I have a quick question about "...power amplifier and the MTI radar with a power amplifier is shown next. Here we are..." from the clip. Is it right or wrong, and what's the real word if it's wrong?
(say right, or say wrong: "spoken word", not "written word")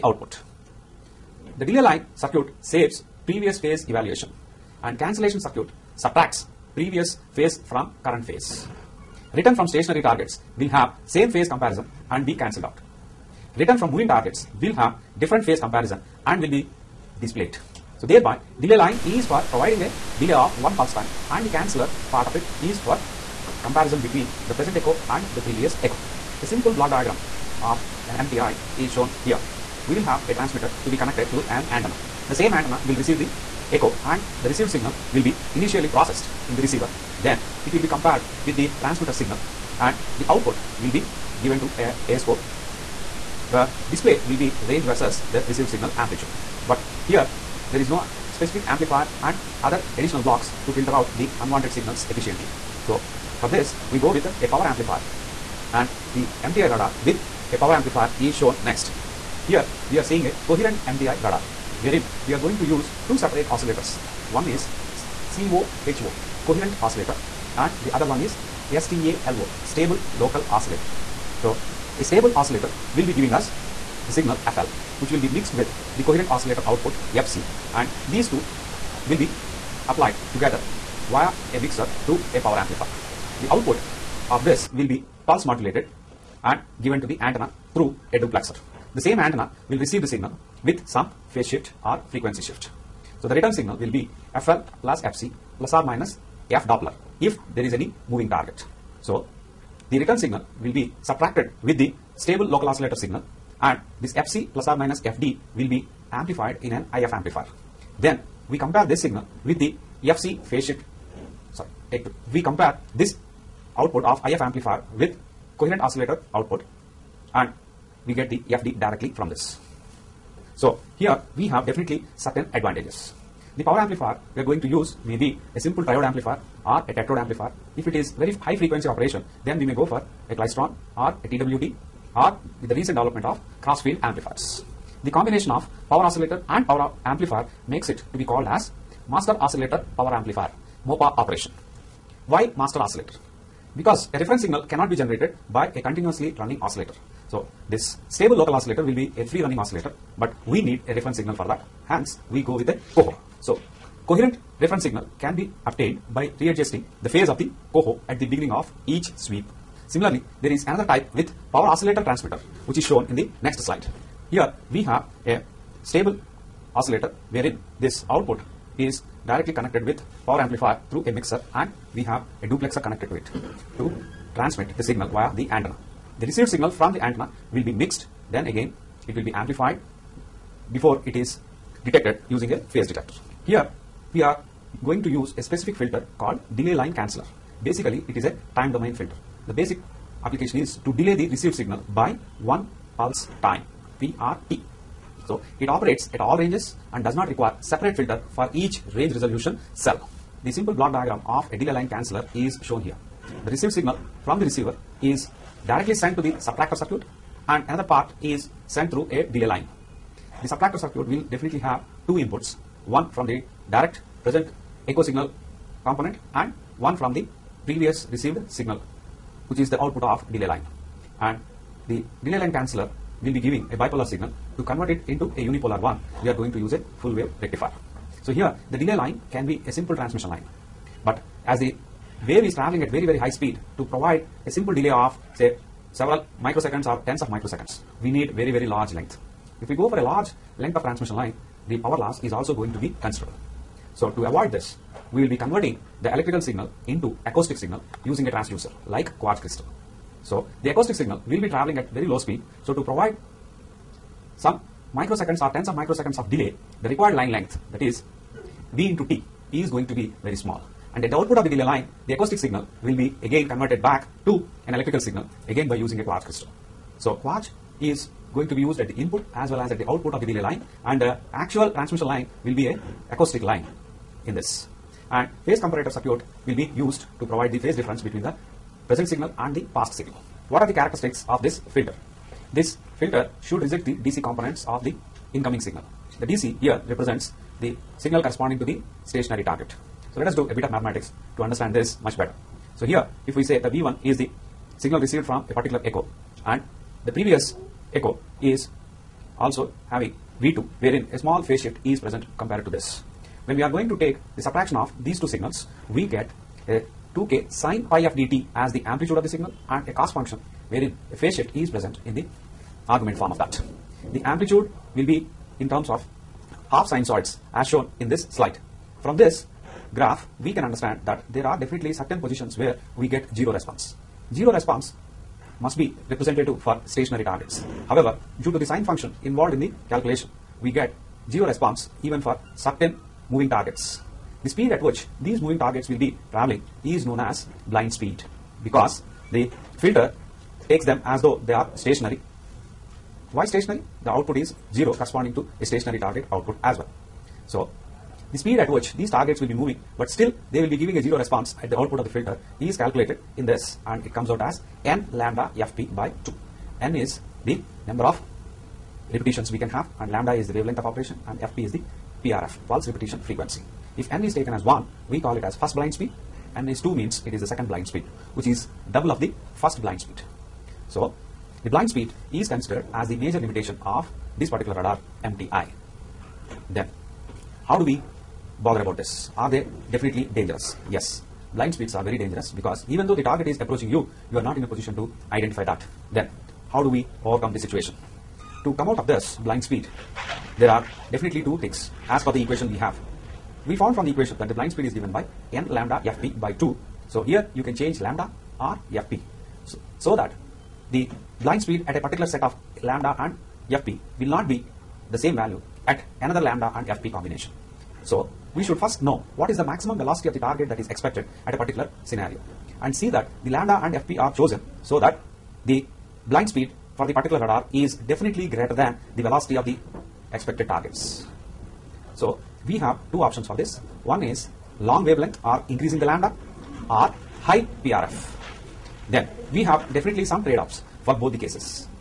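right.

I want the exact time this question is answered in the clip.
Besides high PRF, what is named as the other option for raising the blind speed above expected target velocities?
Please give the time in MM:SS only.
07:04.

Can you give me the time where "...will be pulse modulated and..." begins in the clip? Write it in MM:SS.
01:24.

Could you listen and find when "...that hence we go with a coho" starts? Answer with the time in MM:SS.
02:31.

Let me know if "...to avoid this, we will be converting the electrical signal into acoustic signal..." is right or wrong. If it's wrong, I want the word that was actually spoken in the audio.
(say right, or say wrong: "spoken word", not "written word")
right.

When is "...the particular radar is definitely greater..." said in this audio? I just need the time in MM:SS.
06:57.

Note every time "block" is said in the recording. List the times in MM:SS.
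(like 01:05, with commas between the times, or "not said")
00:26, 00:50, 03:20.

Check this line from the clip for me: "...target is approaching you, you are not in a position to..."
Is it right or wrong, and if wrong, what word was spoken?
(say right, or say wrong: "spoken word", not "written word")
right.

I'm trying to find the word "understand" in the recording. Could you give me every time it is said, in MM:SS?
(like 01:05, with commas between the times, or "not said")
04:51, 05:20.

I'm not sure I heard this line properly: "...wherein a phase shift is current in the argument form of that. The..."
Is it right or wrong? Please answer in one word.
wrong.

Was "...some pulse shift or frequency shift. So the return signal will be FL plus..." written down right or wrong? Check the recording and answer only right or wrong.
wrong.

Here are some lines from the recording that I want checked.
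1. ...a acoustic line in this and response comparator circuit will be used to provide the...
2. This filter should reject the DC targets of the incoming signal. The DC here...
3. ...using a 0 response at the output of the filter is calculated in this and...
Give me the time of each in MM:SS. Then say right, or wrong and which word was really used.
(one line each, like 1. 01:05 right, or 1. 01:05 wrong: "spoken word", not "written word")
1. 04:32 wrong: "phase", not "response"
2. 04:42 wrong: "components", not "targets"
3. 05:50 wrong: "giving", not "using".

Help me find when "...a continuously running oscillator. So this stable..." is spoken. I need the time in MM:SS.
02:25.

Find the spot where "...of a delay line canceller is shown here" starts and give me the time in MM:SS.
03:21.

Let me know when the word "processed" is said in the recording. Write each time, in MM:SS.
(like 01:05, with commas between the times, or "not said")
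00:35.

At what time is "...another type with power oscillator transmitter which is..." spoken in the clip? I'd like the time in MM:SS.
02:40.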